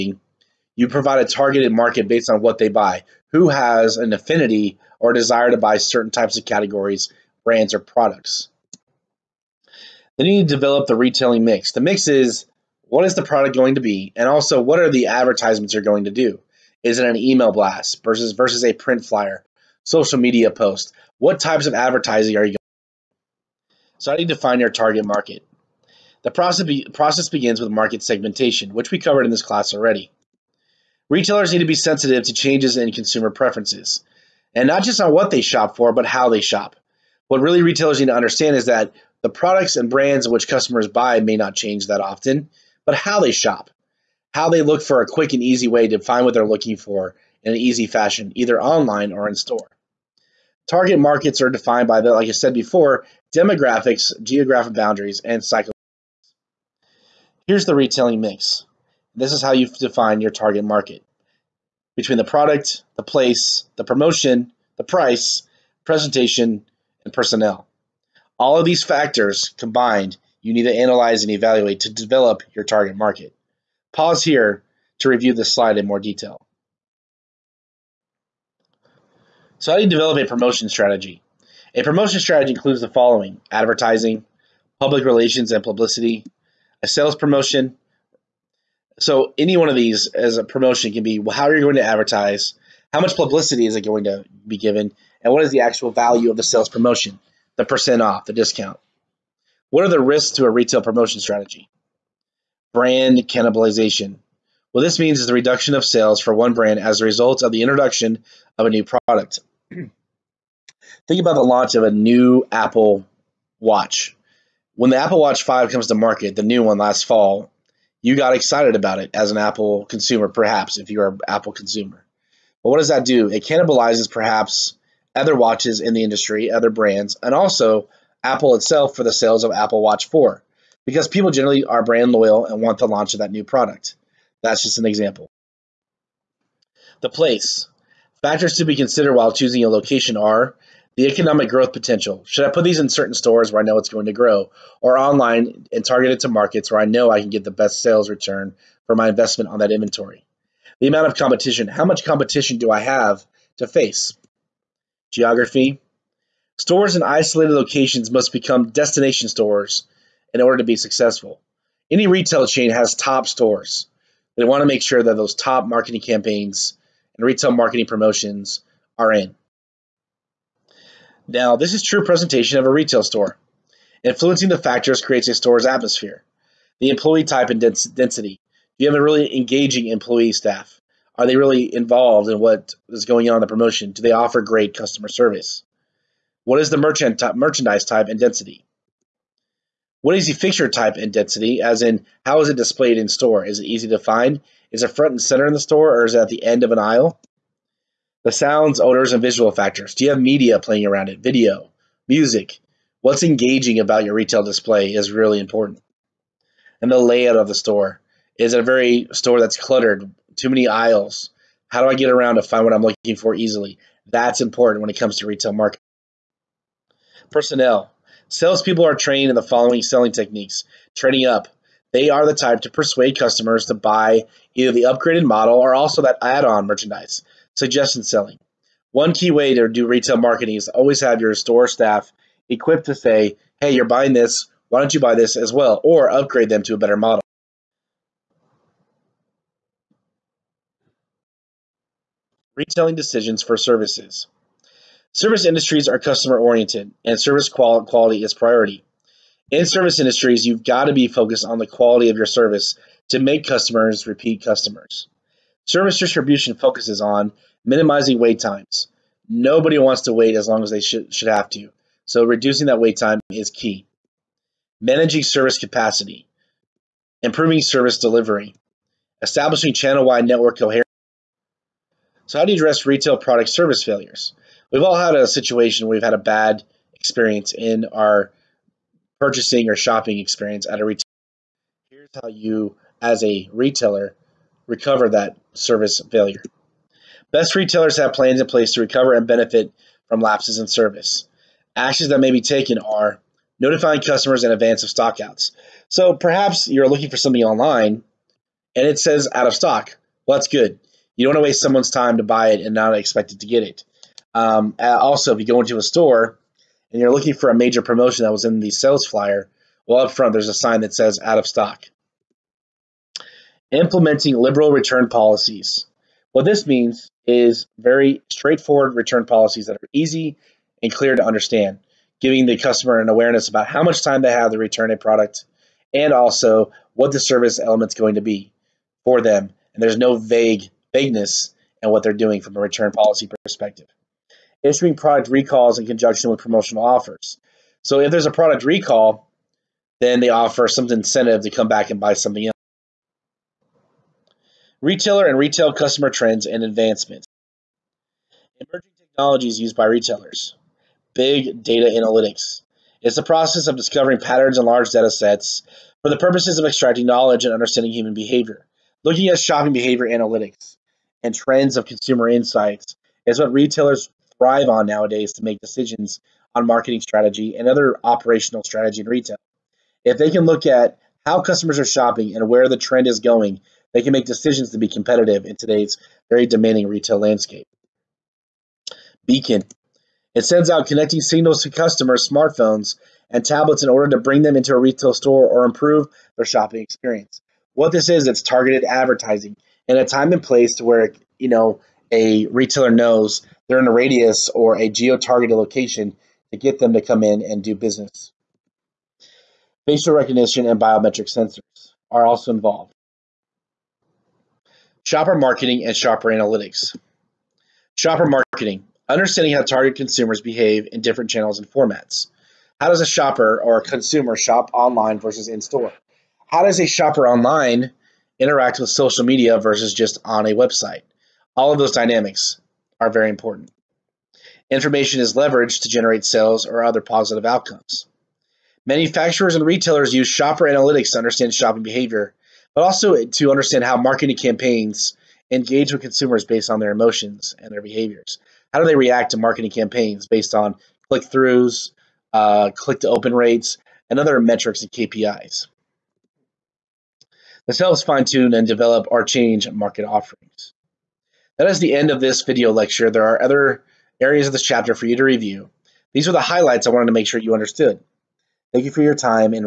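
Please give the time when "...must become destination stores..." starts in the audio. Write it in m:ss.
2:38.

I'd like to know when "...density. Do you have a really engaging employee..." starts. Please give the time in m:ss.
2:57.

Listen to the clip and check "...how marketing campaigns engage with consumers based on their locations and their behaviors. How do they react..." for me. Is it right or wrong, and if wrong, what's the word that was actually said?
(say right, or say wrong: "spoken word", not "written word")
wrong: "emotions", not "locations".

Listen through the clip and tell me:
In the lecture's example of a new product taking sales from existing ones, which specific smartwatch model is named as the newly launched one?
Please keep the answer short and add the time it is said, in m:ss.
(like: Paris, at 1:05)
Apple Watch 5, at 1:54.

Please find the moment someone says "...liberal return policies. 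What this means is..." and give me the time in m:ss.
5:14.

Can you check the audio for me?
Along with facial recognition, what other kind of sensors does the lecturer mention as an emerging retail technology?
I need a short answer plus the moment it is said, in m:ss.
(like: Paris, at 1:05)
Biometric sensors, at 6:40.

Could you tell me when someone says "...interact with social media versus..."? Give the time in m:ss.
6:58.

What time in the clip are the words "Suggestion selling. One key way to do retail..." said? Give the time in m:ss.
3:47.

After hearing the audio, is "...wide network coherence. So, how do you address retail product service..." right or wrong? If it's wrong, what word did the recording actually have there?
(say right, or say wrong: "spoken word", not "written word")
right.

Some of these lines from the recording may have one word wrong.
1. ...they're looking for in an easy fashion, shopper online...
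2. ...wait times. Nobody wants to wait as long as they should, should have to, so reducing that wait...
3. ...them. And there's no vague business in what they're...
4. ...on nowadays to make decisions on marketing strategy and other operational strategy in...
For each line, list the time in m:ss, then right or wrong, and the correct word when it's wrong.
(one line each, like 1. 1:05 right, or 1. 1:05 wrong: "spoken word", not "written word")
1. 0:46 wrong: "either", not "shopper"
2. 4:18 right
3. 5:29 wrong: "vagueness", not "business"
4. 6:04 right.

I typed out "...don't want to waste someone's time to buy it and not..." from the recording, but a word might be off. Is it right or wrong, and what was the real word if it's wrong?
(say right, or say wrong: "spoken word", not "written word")
right.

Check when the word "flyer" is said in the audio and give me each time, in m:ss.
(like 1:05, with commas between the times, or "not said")
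0:19, 5:09.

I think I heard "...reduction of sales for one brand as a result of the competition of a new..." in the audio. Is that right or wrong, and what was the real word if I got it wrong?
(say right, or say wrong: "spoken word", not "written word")
wrong: "introduction", not "competition".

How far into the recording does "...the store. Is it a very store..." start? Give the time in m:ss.
3:27.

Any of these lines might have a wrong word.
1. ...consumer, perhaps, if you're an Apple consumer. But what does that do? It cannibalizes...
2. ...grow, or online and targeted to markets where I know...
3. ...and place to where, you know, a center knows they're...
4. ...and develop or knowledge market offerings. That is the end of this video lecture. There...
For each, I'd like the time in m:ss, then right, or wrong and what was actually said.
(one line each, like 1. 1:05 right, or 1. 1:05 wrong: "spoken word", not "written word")
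1. 1:59 right
2. 2:24 right
3. 6:30 wrong: "retailer", not "center"
4. 7:28 wrong: "change", not "knowledge".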